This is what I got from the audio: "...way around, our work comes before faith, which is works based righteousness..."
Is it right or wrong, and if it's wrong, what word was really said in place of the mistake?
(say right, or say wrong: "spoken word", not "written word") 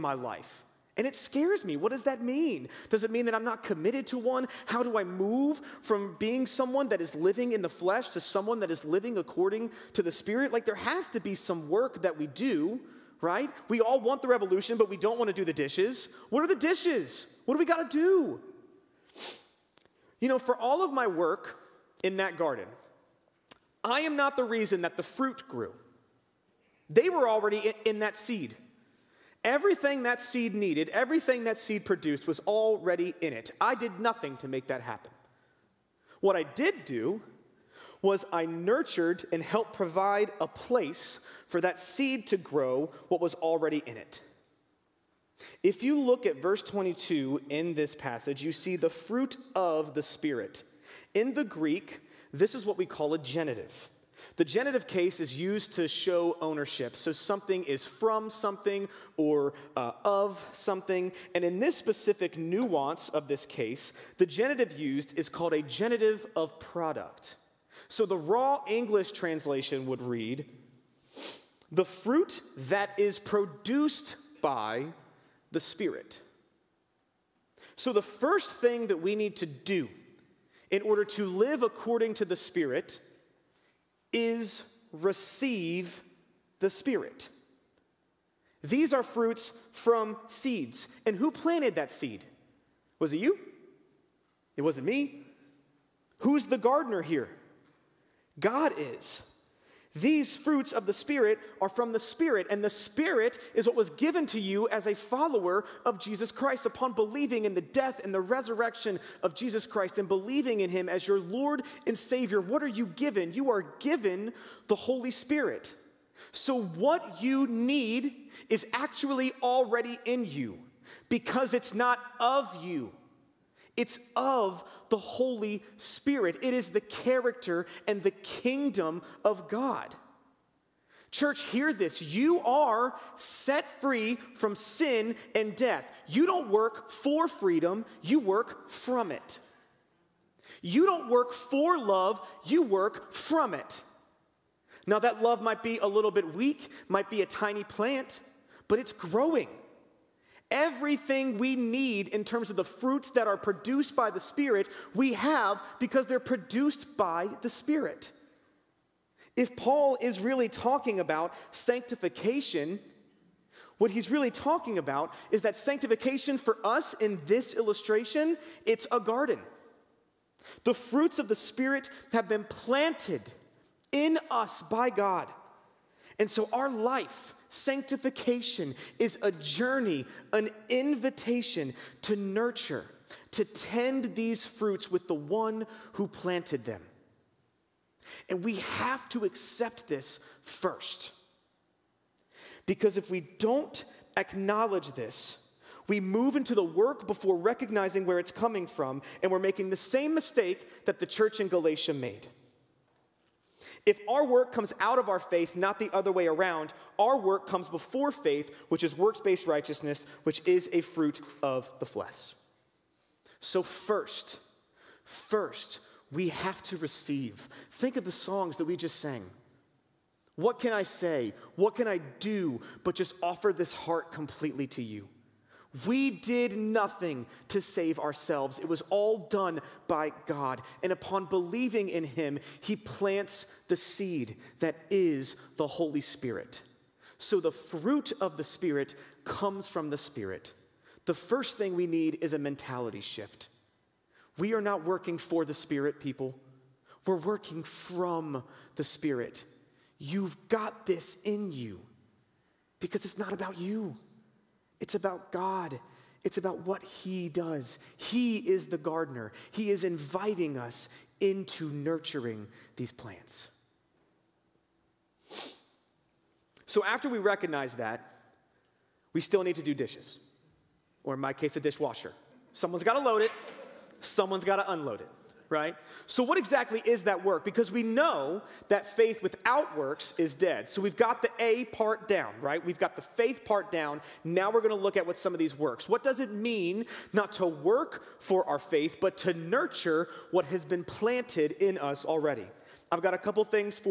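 right.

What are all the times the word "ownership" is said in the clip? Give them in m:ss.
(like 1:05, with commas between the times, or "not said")
0:56.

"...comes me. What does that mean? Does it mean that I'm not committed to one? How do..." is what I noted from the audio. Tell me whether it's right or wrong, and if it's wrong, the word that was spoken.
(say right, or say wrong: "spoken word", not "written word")
wrong: "scares", not "comes".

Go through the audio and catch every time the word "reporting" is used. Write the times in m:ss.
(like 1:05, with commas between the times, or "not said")
not said.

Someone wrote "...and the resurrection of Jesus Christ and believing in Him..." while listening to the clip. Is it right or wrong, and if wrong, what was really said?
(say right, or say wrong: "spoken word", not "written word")
right.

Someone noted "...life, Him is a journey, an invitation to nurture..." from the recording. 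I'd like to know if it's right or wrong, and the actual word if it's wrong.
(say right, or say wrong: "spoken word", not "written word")
wrong: "Sanctification", not "Him".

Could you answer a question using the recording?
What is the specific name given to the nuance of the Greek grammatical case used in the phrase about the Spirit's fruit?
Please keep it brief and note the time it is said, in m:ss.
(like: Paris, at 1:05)
genitive of product, at 1:05.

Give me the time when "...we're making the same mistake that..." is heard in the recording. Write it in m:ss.
3:19.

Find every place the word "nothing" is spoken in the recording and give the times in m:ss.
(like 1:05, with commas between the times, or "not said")
0:33, 3:46.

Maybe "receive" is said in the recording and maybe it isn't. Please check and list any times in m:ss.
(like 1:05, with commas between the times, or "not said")
1:24, 3:36.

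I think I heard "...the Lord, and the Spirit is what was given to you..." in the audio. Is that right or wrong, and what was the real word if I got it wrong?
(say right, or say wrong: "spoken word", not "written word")
wrong: "Spirit", not "Lord".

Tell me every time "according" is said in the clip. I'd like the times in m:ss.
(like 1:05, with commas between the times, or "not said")
0:09, 1:21.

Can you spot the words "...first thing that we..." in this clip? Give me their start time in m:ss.
1:18.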